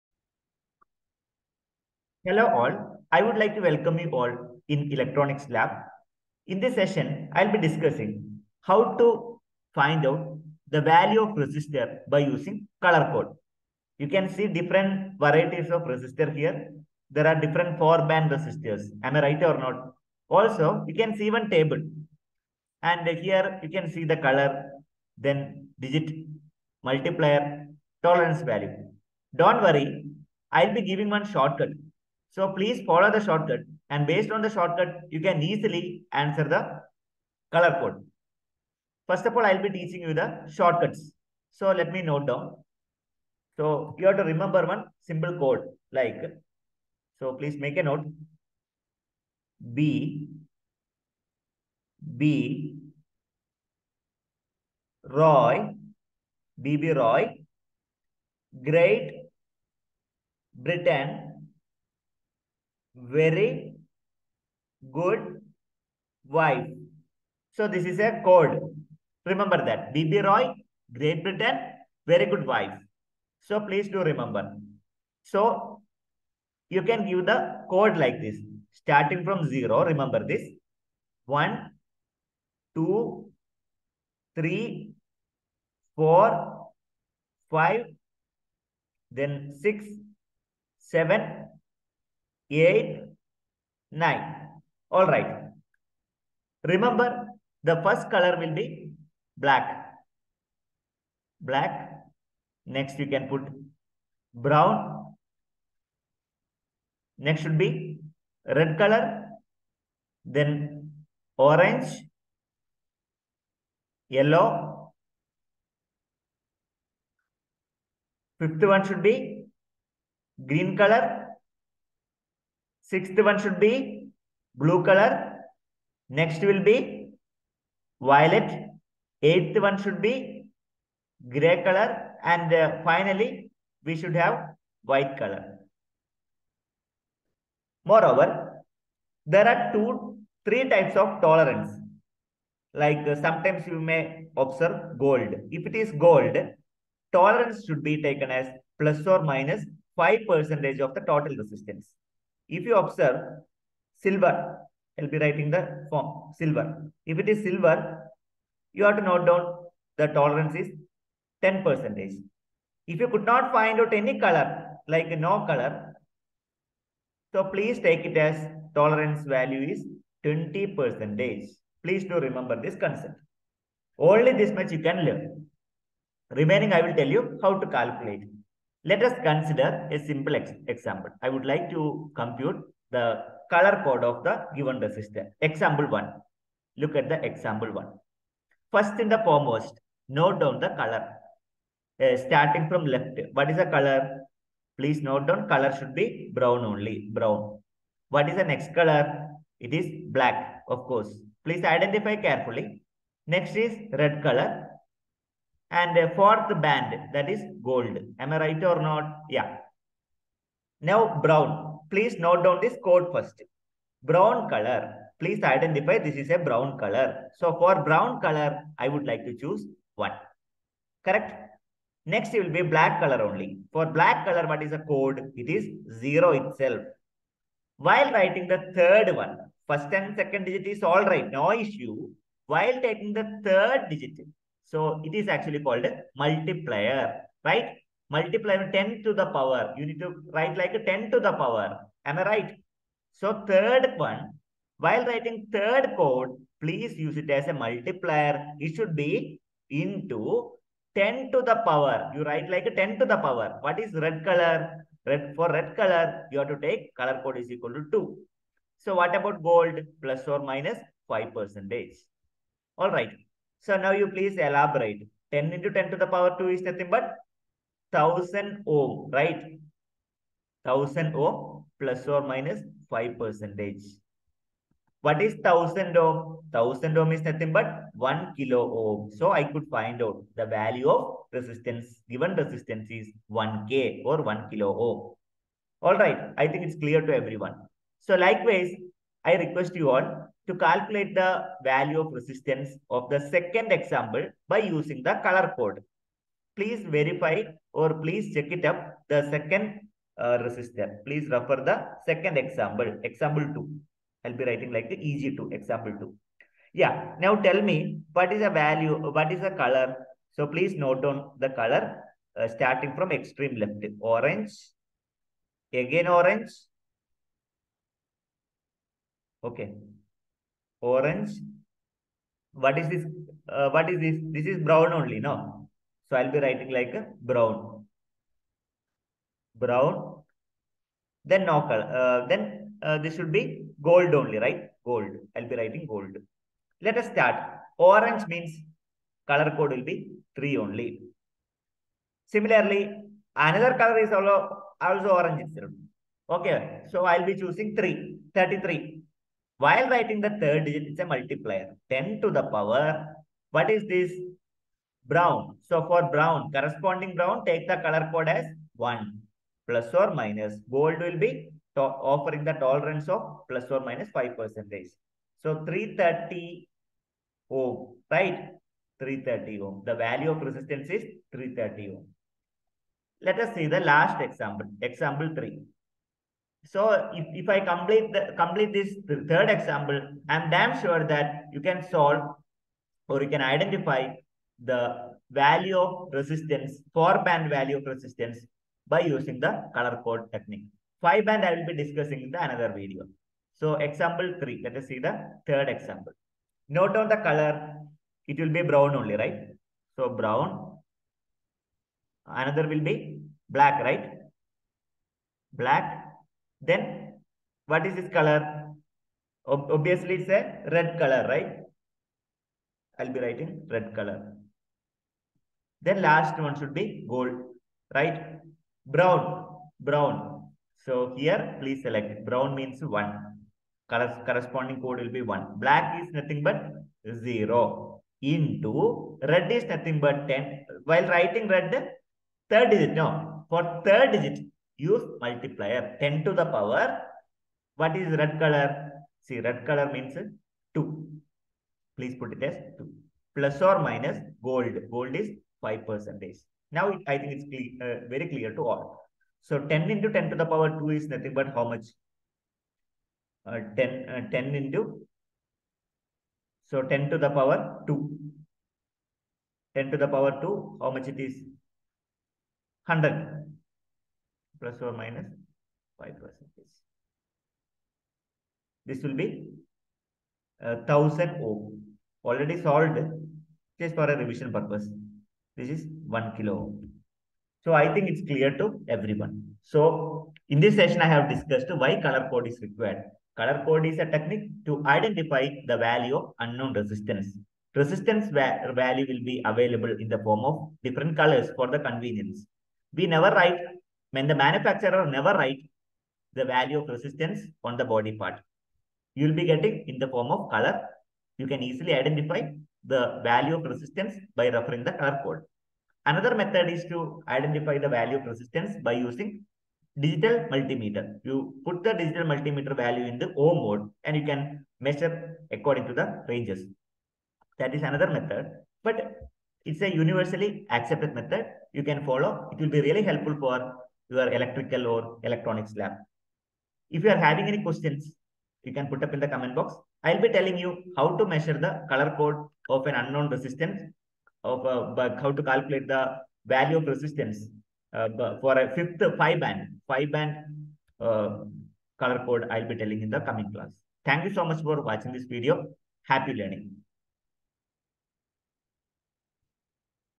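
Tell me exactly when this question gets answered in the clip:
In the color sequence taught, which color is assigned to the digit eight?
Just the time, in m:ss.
2:11.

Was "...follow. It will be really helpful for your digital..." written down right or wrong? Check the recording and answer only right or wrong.
wrong.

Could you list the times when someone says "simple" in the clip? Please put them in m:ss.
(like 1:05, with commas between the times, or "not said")
0:45, 2:59.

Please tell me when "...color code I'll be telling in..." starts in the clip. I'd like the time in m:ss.
9:01.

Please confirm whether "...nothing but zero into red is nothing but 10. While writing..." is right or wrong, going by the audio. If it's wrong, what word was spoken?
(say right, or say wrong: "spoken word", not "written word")
right.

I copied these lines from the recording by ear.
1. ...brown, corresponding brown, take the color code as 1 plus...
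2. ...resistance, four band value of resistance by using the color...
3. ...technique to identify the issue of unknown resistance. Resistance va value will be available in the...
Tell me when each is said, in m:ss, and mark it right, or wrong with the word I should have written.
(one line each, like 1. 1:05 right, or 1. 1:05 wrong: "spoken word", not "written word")
1. 5:56 right
2. 6:26 right
3. 8:04 wrong: "value", not "issue".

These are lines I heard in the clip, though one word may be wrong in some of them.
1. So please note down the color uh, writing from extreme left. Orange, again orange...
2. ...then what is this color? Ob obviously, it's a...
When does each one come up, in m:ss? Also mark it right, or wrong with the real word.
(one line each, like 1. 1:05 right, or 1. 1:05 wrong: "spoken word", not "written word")
1. 5:10 wrong: "starting", not "writing"
2. 6:46 right.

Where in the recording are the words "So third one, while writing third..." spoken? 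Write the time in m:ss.
4:03.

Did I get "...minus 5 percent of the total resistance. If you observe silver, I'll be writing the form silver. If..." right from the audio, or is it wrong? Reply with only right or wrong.
right.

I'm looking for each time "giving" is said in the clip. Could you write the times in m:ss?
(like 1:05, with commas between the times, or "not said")
0:30.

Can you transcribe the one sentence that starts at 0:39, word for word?
First of all, I'll be teaching you the shortcuts.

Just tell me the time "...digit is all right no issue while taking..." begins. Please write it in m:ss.
3:50.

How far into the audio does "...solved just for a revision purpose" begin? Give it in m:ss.
7:52.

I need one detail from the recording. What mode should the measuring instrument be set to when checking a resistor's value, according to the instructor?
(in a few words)
Ohm mode.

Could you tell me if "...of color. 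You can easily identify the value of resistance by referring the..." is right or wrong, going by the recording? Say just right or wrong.
right.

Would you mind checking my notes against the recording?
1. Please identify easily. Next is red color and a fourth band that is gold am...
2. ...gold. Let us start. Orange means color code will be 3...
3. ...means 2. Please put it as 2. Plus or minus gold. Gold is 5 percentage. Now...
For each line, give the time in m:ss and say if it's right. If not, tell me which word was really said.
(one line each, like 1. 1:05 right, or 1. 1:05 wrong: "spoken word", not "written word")
1. 3:21 wrong: "carefully", not "easily"
2. 5:35 right
3. 7:19 right.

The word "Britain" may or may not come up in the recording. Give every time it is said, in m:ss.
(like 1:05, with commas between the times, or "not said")
1:00, 1:11.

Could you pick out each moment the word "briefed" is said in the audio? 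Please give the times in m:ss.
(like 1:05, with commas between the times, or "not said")
not said.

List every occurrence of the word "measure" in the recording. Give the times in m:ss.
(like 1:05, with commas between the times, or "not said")
8:34, 8:51.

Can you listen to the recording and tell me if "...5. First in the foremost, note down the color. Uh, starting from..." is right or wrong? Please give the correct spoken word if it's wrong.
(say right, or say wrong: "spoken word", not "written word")
wrong: "1", not "5".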